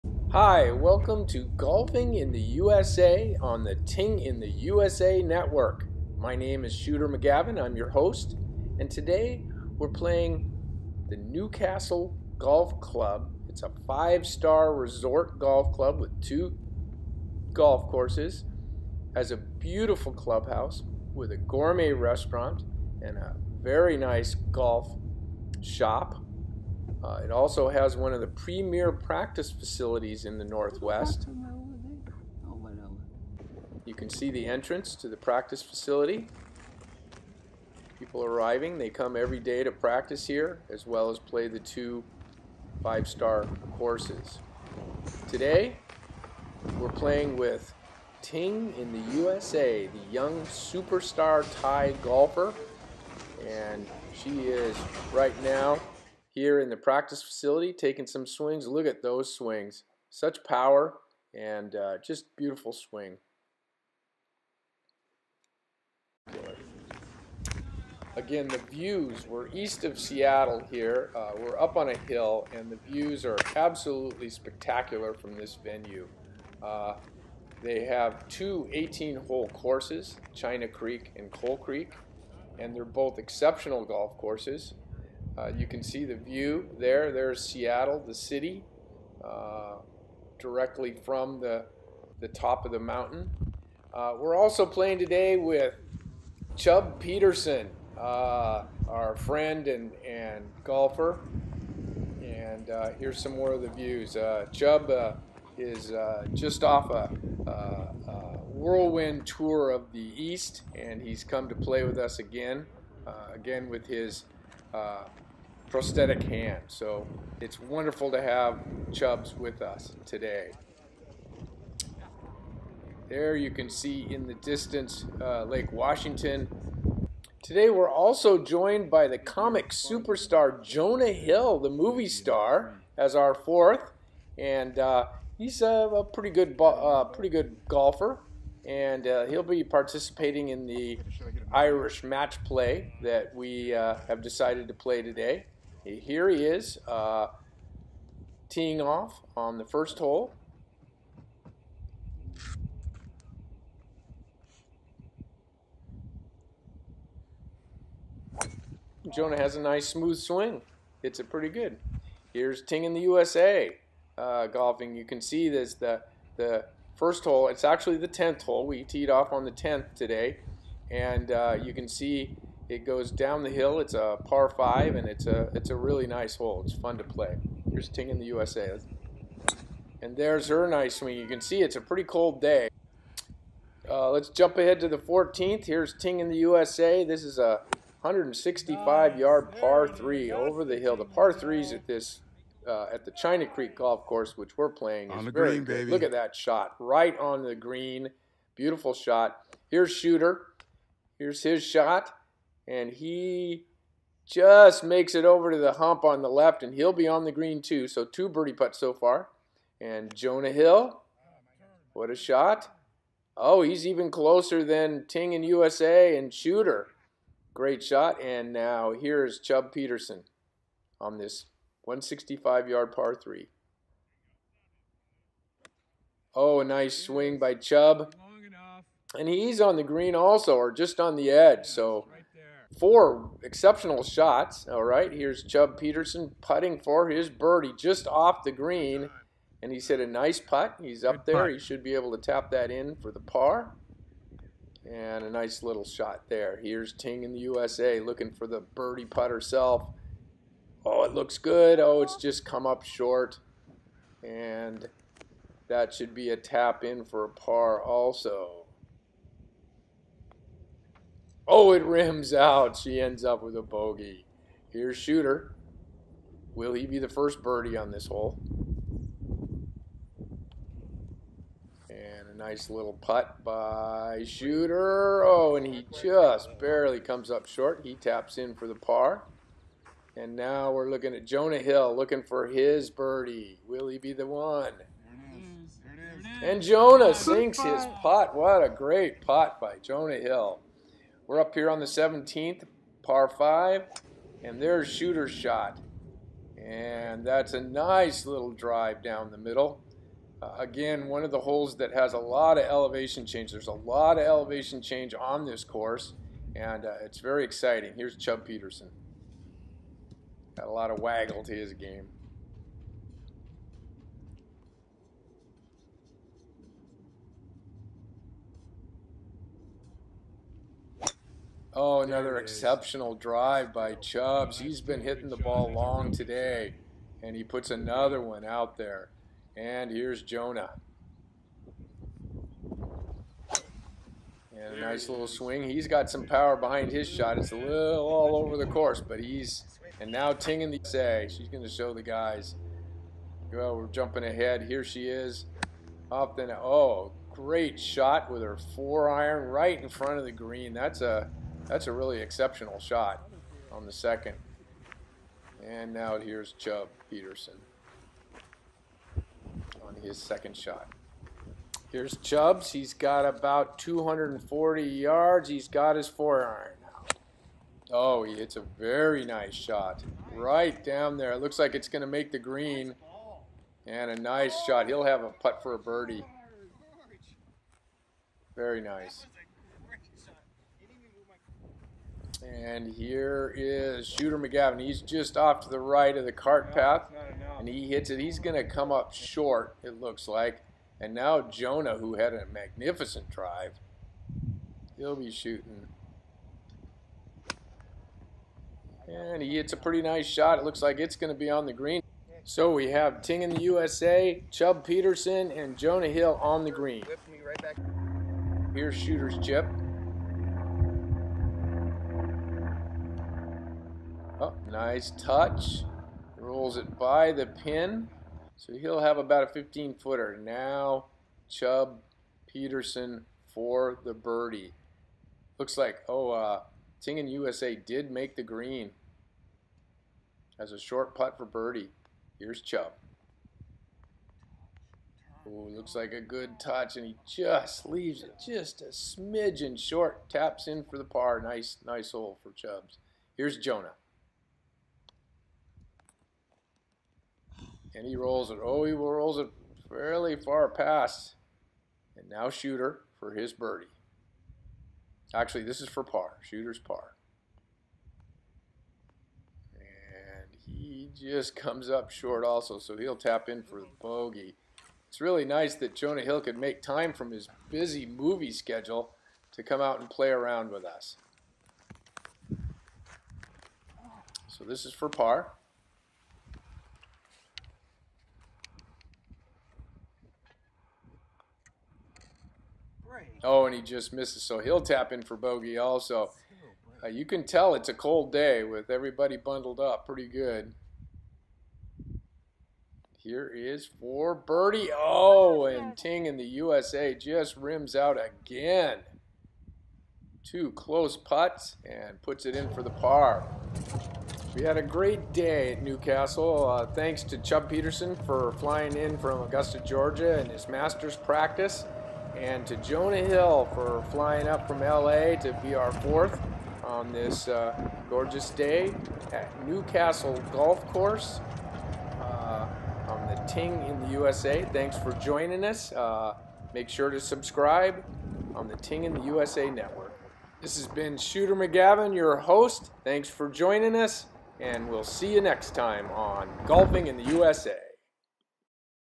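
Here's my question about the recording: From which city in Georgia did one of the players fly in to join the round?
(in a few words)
Augusta.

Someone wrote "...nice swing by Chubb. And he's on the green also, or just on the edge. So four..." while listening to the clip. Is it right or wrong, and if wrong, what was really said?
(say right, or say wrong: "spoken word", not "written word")
right.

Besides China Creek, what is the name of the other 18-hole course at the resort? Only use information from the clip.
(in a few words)
Coal Creek.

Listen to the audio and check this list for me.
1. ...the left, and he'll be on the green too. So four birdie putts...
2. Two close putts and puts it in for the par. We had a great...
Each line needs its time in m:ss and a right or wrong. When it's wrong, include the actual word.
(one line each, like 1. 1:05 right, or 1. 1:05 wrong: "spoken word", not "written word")
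1. 3:26 wrong: "two", not "four"
2. 8:20 right.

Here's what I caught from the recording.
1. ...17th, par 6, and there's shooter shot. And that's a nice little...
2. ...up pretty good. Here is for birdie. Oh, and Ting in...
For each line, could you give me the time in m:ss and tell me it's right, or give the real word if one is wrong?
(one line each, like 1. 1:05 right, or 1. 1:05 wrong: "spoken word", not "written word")
1. 4:51 wrong: "5", not "6"
2. 8:09 right.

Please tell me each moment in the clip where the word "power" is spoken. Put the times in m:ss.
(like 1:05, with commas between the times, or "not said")
1:00, 5:36.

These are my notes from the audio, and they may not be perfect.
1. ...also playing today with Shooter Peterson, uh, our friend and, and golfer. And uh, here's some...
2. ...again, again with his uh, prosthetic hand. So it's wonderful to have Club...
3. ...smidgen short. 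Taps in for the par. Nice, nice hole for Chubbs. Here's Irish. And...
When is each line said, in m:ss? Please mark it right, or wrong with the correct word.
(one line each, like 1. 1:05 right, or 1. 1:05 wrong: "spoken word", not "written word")
1. 1:34 wrong: "Chub", not "Shooter"
2. 1:52 wrong: "Chubbs", not "Club"
3. 7:18 wrong: "Jonah", not "Irish".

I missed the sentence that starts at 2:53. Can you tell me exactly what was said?
It's a par five, and it's a it's a really nice hole.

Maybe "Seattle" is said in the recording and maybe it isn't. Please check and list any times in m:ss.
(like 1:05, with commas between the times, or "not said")
1:09, 1:27.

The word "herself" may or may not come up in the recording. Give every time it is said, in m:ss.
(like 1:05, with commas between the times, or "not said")
4:09.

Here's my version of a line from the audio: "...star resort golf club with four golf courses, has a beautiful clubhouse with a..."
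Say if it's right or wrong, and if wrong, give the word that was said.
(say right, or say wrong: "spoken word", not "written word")
wrong: "two", not "four".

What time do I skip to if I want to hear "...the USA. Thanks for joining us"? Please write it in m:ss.
8:44.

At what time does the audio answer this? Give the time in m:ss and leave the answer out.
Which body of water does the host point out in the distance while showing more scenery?
2:05.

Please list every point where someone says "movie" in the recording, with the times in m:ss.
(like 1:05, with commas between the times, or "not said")
2:11, 7:48.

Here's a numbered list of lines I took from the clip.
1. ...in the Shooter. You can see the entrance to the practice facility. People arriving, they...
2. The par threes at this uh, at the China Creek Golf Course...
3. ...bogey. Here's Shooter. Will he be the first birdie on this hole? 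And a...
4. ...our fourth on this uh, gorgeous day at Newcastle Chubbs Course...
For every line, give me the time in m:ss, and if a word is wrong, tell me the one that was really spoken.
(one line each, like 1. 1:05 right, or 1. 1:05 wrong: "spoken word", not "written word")
1. 0:30 wrong: "Northwest", not "Shooter"
2. 3:10 right
3. 4:23 right
4. 8:35 wrong: "Golf", not "Chubbs".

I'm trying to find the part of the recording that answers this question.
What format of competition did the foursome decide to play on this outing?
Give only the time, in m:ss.
2:21.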